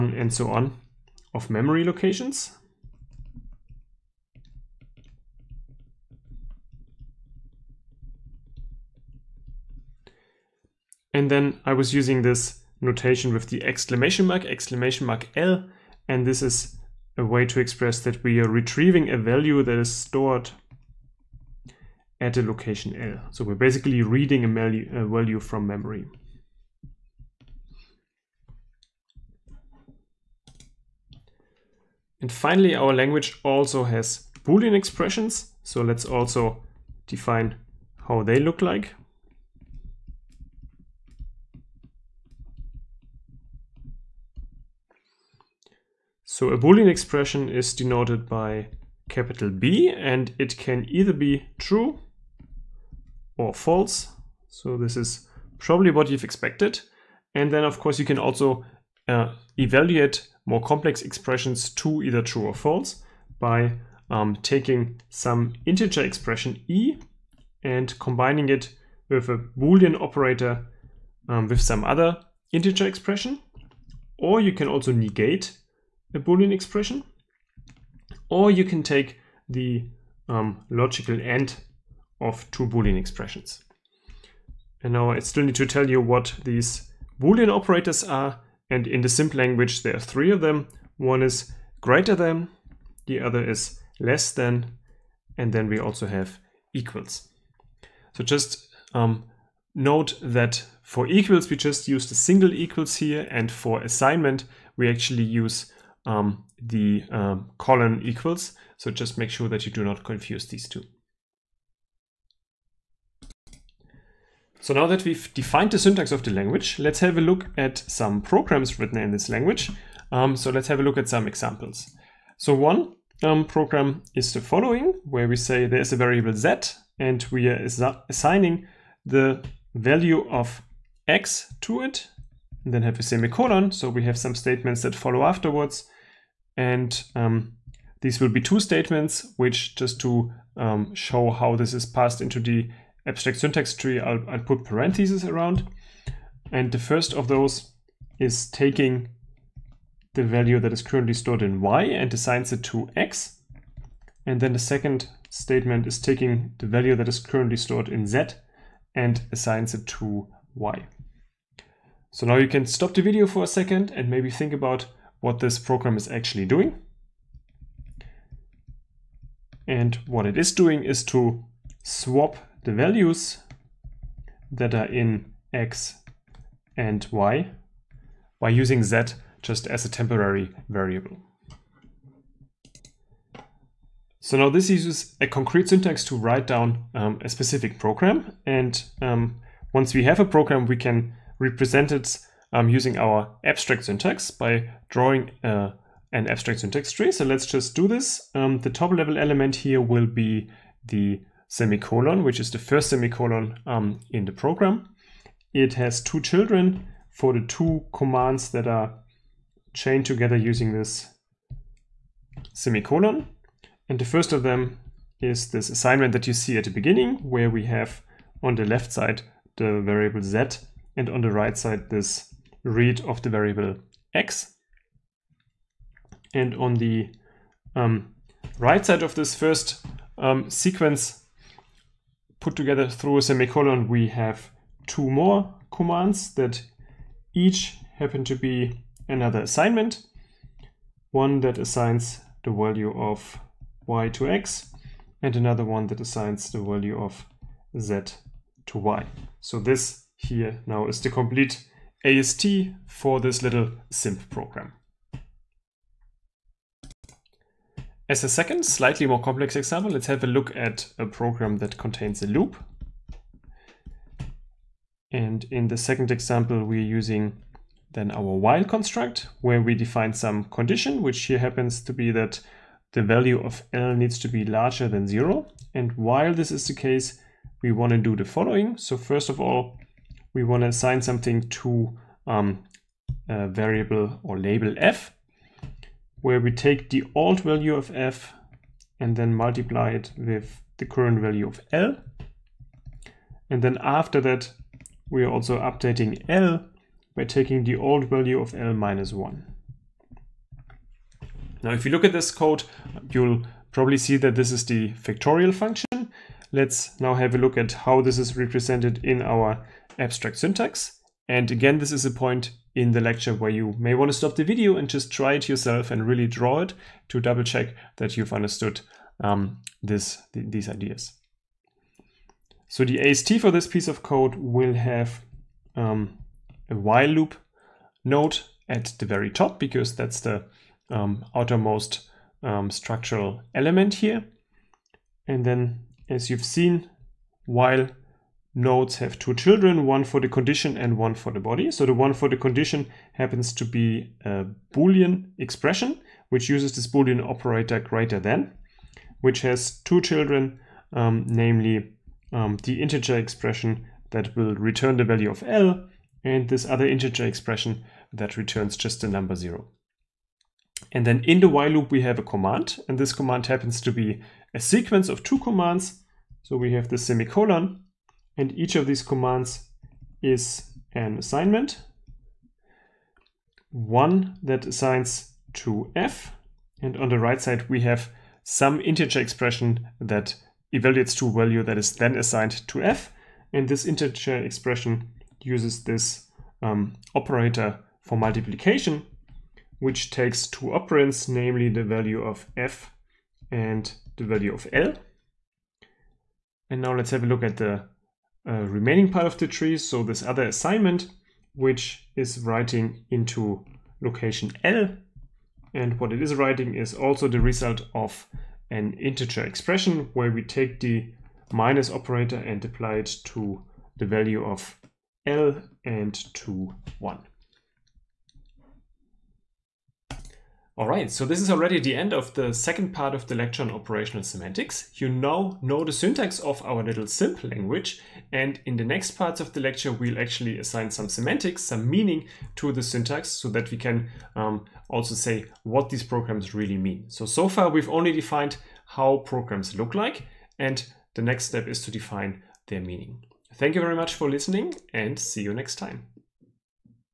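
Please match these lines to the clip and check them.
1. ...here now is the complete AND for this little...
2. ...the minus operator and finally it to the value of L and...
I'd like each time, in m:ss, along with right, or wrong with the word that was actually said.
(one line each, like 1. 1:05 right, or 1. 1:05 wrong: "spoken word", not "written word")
1. 4:10 wrong: "AST", not "AND"
2. 6:50 wrong: "apply", not "finally".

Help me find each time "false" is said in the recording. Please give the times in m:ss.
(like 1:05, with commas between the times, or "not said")
0:53, 1:02.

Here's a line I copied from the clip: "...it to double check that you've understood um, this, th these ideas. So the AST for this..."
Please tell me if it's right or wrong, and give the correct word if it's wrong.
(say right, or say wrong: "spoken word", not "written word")
right.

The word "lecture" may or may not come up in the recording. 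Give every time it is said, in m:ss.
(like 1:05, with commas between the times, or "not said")
5:12, 7:03, 7:09.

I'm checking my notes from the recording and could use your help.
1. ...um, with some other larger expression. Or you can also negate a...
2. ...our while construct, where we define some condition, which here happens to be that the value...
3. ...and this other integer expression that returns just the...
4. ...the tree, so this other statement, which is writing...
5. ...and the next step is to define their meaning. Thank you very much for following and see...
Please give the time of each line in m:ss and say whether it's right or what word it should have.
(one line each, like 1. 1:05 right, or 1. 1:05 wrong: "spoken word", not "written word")
1. 1:11 wrong: "integer", not "larger"
2. 4:28 right
3. 5:56 right
4. 6:39 wrong: "assignment", not "statement"
5. 7:20 wrong: "listening", not "following".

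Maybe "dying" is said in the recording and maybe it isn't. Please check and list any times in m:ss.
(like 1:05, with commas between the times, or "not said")
not said.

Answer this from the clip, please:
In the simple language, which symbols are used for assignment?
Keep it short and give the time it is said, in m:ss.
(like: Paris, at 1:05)
Colon equals, at 1:47.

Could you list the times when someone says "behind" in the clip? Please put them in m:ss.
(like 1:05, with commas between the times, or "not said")
not said.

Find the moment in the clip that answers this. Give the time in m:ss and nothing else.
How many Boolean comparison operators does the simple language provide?
1:29.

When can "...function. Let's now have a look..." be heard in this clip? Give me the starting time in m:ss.
5:05.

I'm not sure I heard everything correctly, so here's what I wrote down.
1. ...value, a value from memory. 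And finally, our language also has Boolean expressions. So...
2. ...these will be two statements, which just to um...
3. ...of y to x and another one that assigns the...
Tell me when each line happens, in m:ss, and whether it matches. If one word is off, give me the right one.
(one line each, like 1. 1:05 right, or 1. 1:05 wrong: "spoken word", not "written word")
1. 0:24 right
2. 2:18 right
3. 4:02 right.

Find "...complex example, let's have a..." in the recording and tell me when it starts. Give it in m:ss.
4:19.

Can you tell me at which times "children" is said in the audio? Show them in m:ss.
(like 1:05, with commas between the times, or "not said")
3:26, 5:39, 5:50.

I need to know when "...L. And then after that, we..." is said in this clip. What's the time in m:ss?
4:51.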